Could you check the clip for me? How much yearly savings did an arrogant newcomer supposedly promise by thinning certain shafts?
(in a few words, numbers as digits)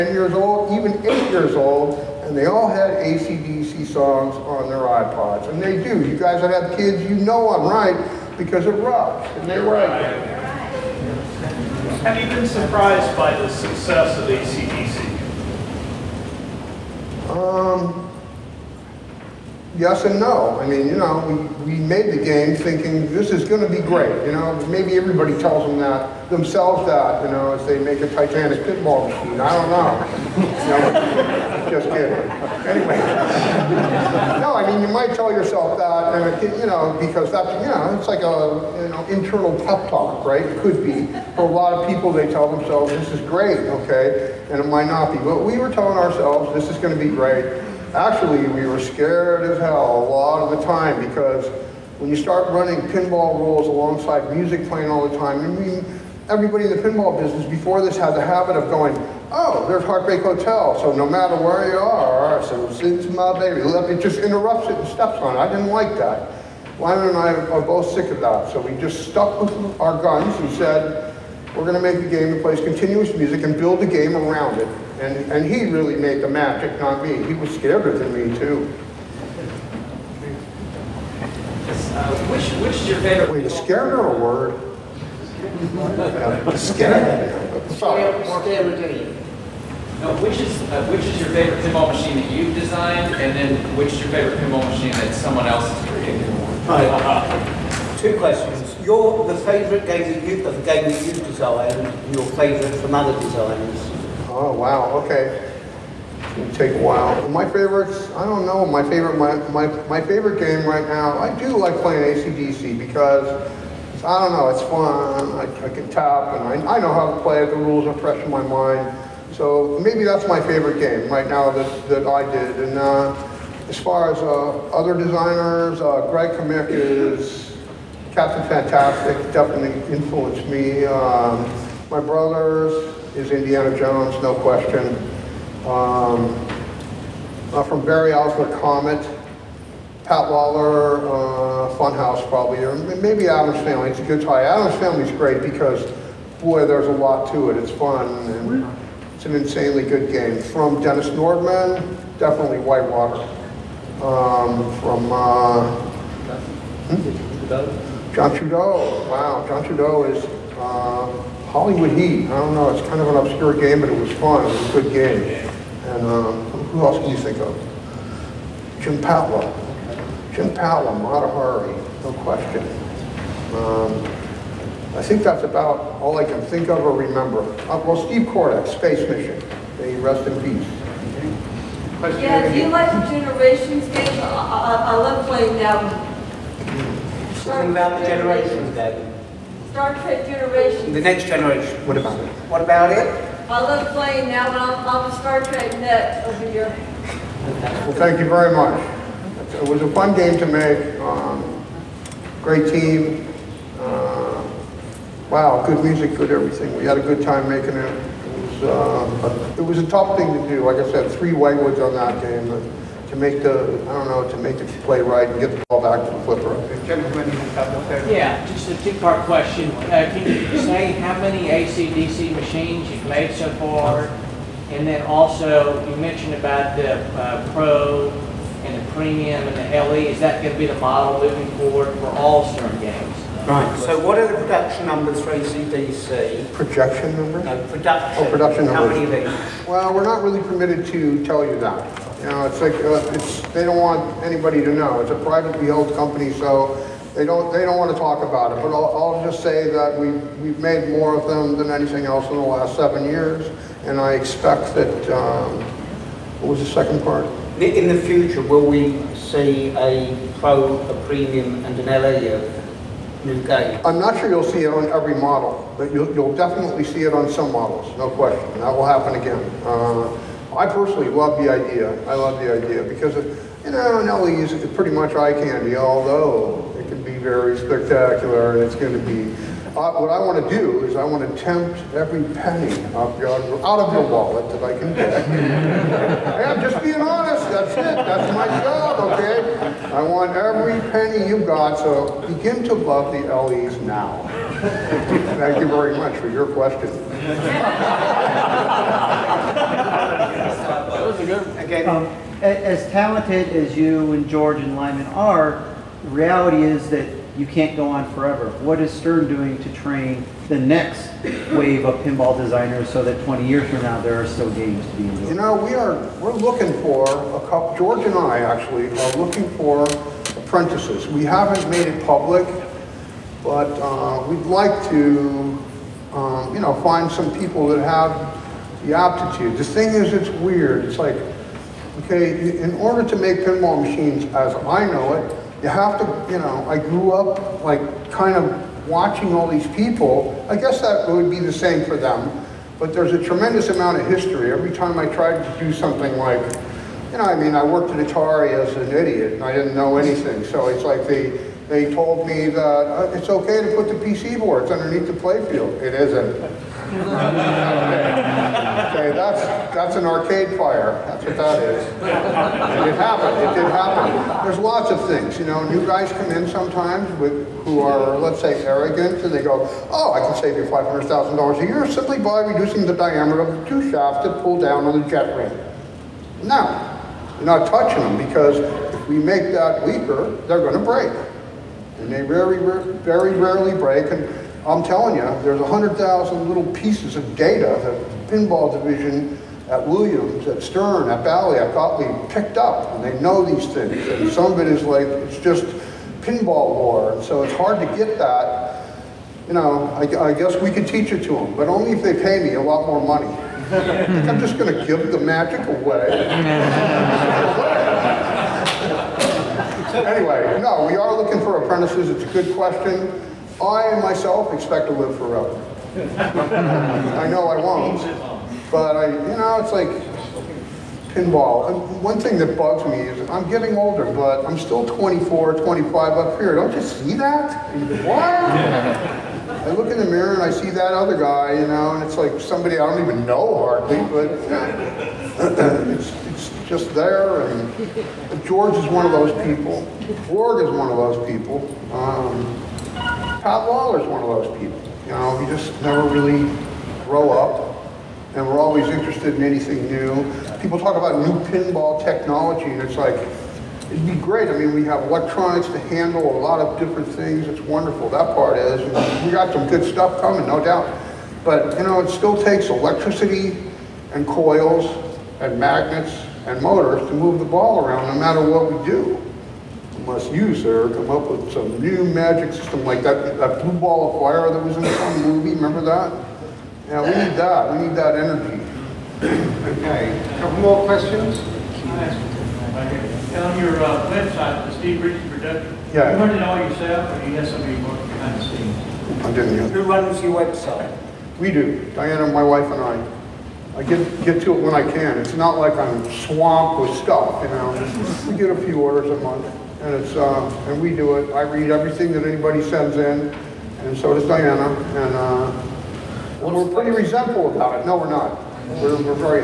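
$500,000.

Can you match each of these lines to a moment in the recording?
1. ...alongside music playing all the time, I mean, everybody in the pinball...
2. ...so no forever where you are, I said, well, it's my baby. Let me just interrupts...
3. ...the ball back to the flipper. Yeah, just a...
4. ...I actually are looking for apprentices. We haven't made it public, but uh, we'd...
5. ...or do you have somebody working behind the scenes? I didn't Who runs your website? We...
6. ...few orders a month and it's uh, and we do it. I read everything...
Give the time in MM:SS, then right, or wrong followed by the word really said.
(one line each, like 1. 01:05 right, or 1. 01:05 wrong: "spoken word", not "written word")
1. 00:53 right
2. 01:00 wrong: "matter", not "forever"
3. 03:35 right
4. 05:18 right
5. 08:07 right
6. 08:18 right.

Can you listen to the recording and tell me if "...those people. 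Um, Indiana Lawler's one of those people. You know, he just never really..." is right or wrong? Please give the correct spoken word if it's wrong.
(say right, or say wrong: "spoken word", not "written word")
wrong: "Todd", not "Indiana".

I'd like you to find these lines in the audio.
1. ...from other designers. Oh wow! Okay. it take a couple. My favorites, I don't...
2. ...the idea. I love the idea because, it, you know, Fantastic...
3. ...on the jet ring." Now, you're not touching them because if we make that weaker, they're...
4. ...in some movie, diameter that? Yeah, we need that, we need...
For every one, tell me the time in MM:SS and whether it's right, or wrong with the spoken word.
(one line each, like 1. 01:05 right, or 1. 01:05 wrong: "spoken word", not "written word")
1. 01:42 wrong: "while", not "couple"
2. 04:31 wrong: "Nelly", not "Fantastic"
3. 06:14 right
4. 07:54 wrong: "remember", not "diameter".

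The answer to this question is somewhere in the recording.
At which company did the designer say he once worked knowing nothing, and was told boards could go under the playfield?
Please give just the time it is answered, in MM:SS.
05:48.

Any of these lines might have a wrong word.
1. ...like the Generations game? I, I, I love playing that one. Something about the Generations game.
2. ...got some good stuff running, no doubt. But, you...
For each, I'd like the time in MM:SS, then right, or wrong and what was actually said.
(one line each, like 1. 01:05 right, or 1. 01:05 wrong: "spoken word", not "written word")
1. 03:02 right
2. 07:39 wrong: "coming", not "running".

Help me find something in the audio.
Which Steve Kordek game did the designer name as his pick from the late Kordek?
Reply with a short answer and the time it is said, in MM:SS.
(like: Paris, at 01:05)
Space Mission, at 02:58.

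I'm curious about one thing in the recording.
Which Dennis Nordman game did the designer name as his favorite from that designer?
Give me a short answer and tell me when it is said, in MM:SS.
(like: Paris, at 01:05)
Whitewater, at 02:32.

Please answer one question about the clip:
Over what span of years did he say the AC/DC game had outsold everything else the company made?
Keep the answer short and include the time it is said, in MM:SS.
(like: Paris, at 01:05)
7 years, at 04:12.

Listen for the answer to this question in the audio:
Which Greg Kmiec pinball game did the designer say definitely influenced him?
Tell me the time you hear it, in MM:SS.
02:08.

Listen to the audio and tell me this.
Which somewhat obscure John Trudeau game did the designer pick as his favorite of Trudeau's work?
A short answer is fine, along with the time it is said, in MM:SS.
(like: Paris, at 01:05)
Hollywood Heat, at 02:41.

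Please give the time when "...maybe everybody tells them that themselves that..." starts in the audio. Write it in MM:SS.
00:24.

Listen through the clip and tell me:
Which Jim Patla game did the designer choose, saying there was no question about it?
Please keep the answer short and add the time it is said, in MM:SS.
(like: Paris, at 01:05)
Mata Hari, at 02:50.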